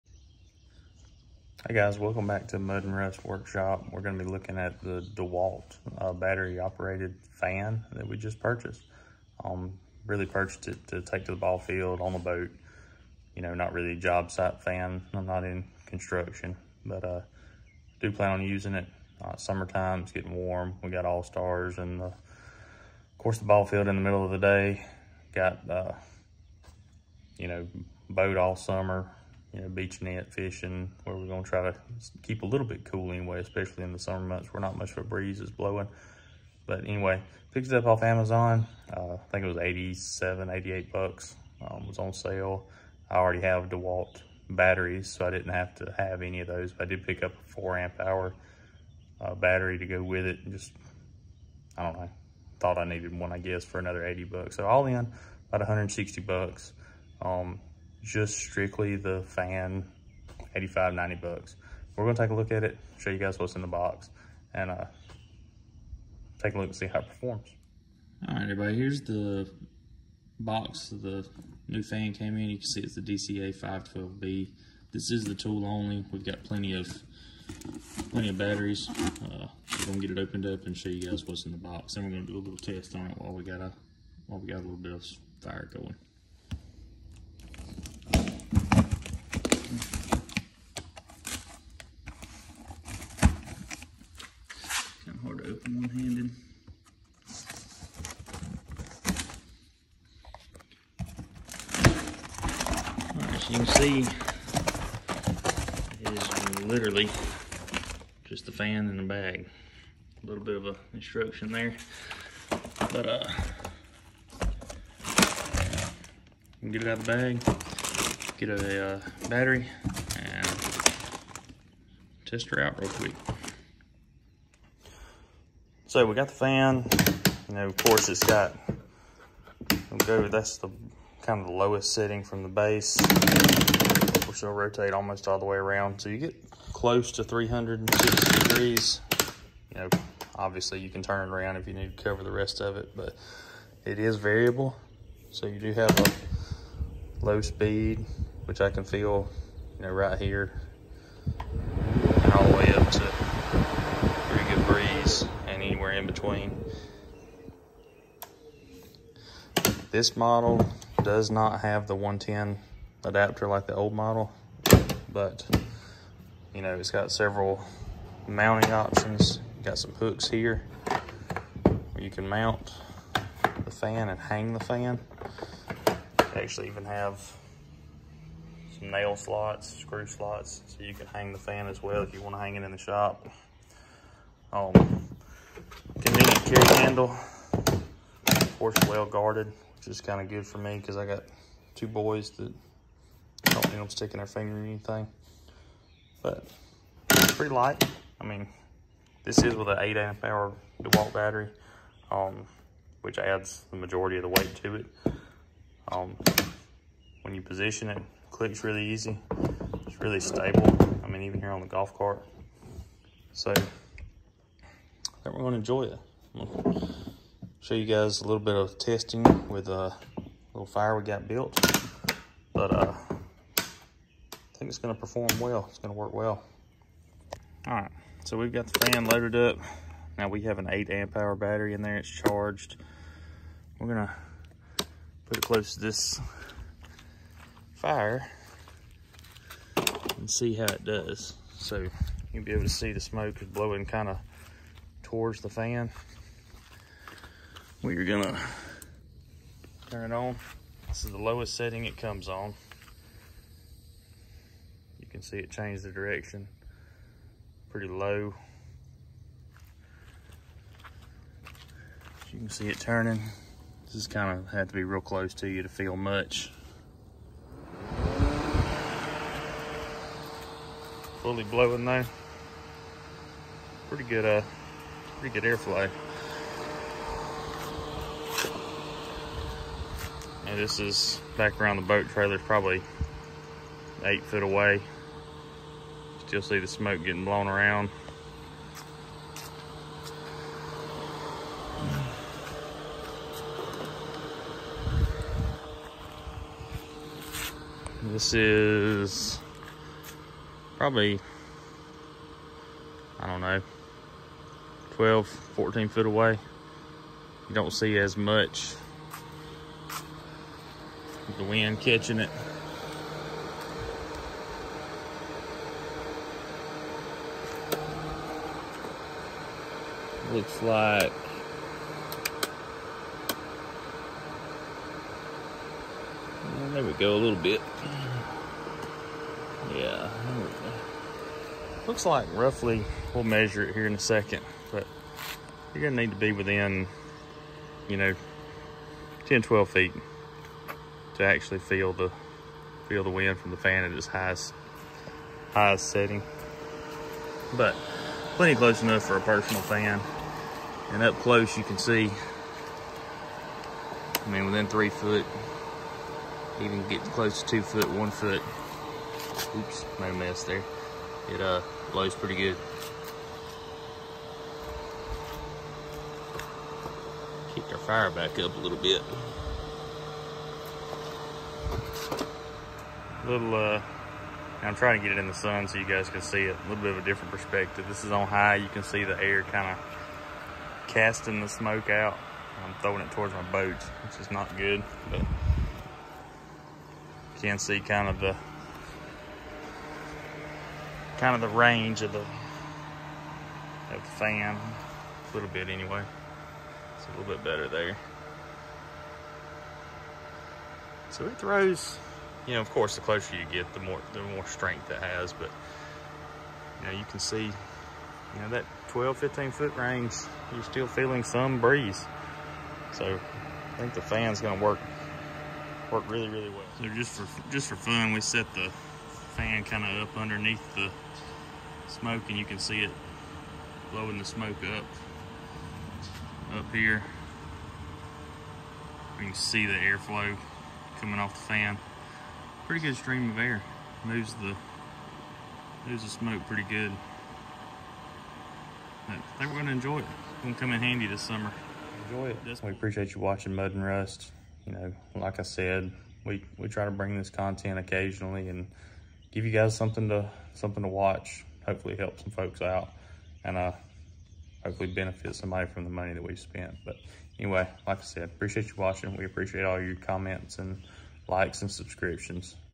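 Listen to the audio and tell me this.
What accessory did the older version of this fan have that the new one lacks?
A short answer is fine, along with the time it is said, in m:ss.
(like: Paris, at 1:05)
110 adapter, at 2:41.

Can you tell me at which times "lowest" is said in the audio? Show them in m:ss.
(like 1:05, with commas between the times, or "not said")
2:11, 4:11.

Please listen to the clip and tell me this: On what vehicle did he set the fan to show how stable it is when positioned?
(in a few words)
golf cart.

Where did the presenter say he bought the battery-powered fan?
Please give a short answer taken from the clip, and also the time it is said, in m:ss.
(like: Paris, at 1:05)
Amazon, at 0:38.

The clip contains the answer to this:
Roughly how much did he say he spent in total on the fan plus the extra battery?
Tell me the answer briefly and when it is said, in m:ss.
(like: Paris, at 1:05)
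$160, at 0:55.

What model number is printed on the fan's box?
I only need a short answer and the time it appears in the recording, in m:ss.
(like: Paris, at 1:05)
DCE 512B, at 1:13.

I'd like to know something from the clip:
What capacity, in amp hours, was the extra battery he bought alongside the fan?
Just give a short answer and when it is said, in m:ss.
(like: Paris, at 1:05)
4 amp hour, at 0:47.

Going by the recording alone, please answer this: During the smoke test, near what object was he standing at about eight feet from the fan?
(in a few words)
boat trailer.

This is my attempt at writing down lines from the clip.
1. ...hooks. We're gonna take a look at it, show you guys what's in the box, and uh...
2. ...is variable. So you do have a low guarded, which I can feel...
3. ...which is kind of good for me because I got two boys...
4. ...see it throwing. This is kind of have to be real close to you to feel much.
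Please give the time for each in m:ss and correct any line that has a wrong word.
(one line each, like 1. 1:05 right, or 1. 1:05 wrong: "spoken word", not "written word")
1. 1:01 wrong: "bucks", not "hooks"
2. 2:23 wrong: "speed", not "guarded"
3. 3:09 right
4. 4:22 wrong: "turning", not "throwing".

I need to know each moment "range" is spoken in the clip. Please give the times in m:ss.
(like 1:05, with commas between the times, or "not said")
6:31, 6:49.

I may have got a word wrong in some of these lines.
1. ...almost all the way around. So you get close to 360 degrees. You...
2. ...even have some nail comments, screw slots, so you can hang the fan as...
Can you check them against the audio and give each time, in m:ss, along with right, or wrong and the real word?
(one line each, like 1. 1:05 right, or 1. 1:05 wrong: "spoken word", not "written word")
1. 2:14 right
2. 2:56 wrong: "slots", not "comments".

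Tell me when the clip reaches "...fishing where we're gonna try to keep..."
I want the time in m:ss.
0:30.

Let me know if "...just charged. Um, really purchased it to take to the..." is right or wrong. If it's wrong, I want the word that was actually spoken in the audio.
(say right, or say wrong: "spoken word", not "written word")
wrong: "purchased", not "charged".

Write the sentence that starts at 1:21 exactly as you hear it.
and we're gonna do a little test on it while we got a while we got a little bit of fire going.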